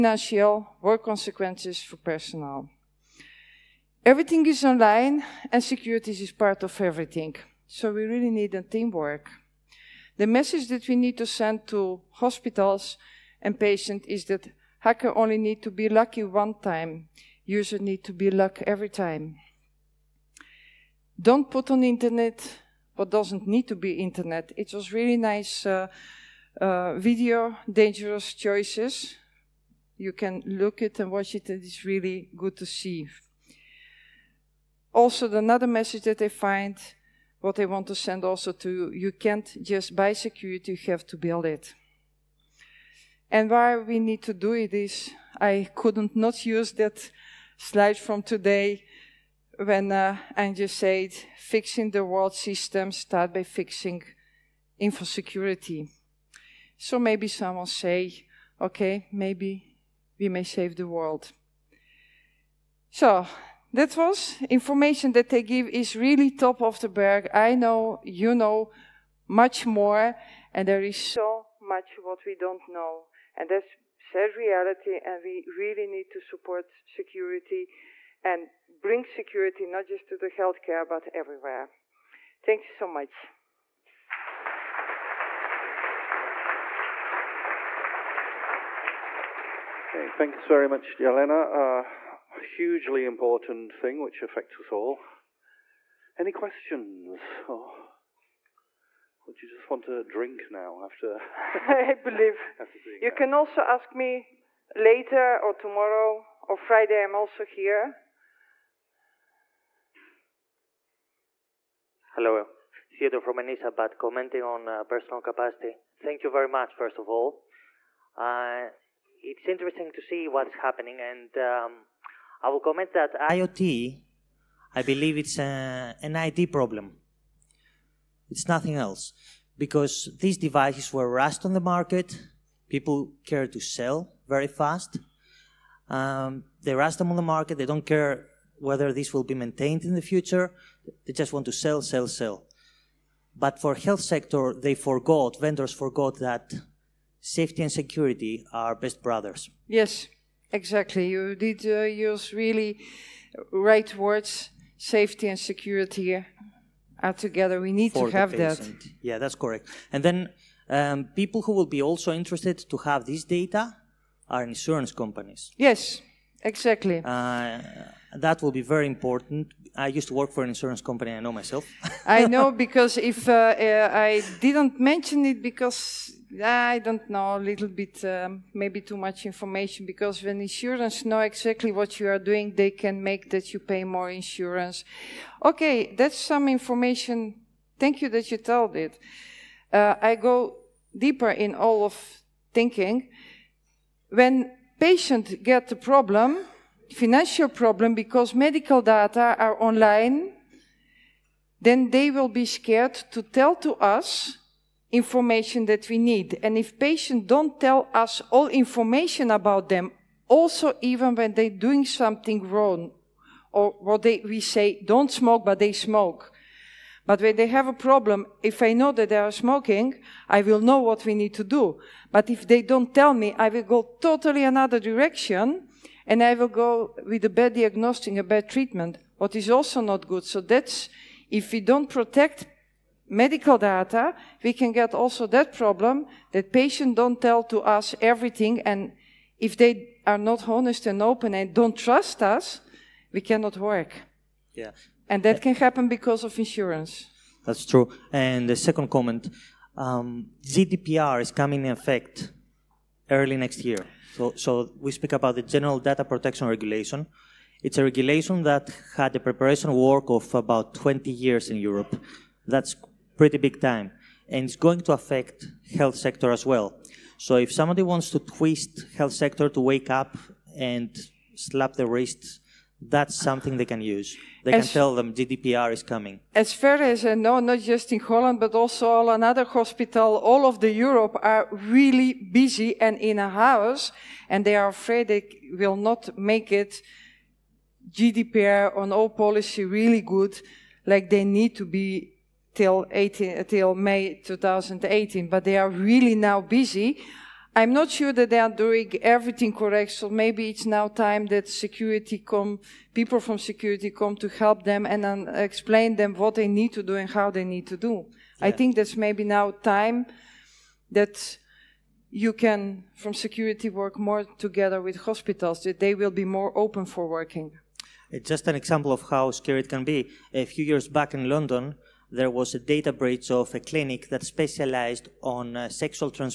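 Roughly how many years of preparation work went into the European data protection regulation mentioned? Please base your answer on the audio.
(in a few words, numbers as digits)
20.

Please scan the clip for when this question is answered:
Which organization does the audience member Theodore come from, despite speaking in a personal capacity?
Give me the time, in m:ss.
1:53.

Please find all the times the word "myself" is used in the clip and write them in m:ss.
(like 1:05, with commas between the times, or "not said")
2:51.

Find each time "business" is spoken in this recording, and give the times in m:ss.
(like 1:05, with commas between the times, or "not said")
not said.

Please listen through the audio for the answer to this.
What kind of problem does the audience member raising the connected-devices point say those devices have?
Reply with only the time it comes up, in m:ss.
2:06.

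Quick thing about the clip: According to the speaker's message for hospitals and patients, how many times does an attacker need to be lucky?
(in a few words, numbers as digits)
1 time.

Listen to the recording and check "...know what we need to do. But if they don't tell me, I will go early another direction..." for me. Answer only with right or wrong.
wrong.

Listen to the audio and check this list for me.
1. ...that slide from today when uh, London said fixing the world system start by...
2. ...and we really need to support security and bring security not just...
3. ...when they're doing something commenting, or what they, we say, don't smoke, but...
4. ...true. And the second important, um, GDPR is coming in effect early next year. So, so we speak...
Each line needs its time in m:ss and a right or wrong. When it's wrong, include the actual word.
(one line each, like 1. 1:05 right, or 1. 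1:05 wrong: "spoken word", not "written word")
1. 0:46 wrong: "Andrew", not "London"
2. 1:15 right
3. 3:31 wrong: "wrong", not "commenting"
4. 4:07 wrong: "comment", not "important".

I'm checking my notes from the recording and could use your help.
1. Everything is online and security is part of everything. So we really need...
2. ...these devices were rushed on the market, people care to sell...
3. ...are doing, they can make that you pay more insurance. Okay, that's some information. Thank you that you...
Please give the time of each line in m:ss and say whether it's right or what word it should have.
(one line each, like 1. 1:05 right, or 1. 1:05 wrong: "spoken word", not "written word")
1. 0:04 right
2. 2:10 right
3. 3:02 right.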